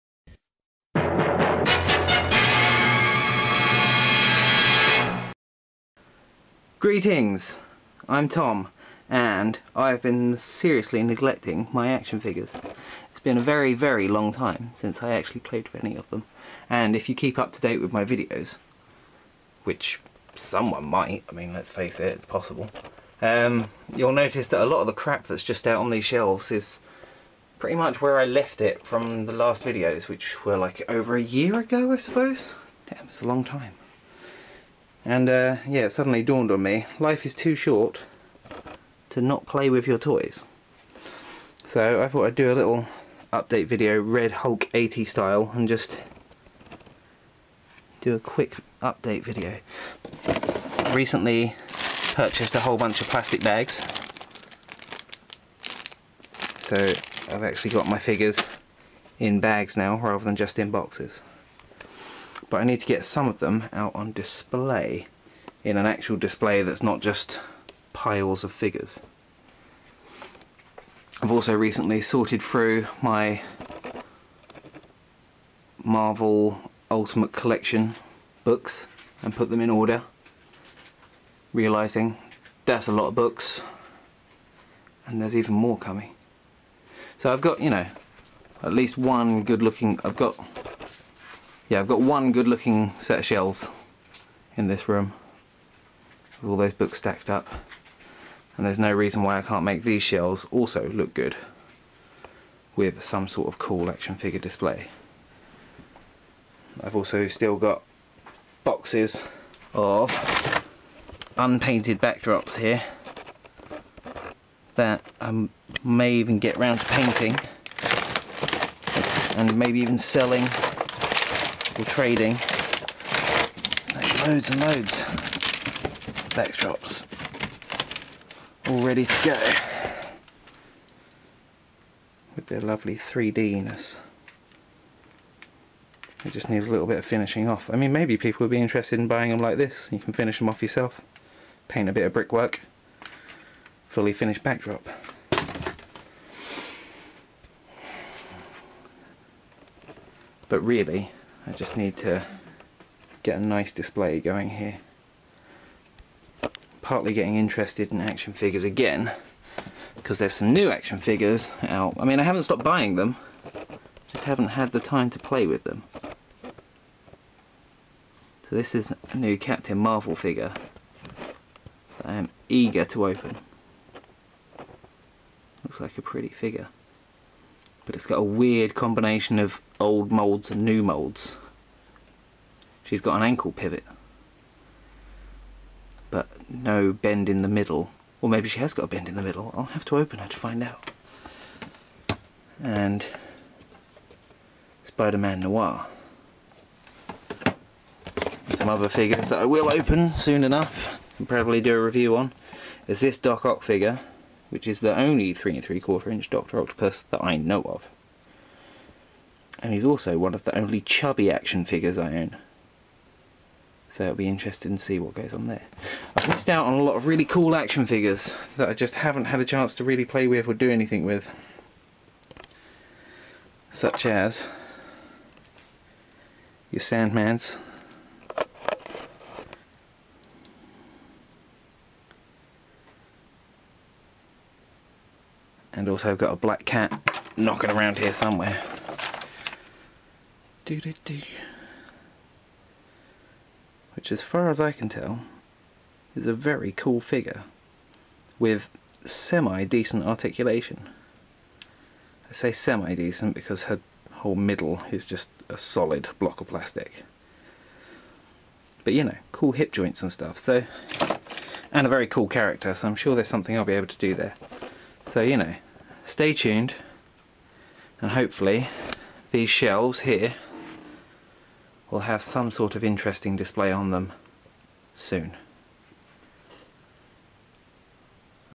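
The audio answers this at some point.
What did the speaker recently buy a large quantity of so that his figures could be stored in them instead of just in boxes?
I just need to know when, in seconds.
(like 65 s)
53 s.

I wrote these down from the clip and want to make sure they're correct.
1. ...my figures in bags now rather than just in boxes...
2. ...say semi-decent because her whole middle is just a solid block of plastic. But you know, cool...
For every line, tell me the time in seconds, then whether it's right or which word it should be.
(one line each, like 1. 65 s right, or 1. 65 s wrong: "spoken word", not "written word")
1. 57 s right
2. 252 s right.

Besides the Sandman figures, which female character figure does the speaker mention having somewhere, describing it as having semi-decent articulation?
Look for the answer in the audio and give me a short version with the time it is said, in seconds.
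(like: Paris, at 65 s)
Black Cat, at 236 s.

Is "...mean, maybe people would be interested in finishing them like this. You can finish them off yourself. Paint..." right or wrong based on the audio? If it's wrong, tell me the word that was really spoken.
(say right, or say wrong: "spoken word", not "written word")
wrong: "buying", not "finishing".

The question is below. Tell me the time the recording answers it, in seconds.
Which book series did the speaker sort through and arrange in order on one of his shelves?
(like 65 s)
75 s.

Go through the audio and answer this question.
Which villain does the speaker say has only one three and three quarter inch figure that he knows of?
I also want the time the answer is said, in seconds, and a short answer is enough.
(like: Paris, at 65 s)
Doc Ock, at 203 s.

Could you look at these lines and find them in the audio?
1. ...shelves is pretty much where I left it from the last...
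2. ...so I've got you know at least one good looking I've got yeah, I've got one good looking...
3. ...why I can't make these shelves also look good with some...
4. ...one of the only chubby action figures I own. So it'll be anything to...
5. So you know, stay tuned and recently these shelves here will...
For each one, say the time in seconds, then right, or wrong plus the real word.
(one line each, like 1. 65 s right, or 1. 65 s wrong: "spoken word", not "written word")
1. 26 s right
2. 87 s right
3. 99 s right
4. 210 s wrong: "interesting", not "anything"
5. 265 s wrong: "hopefully", not "recently".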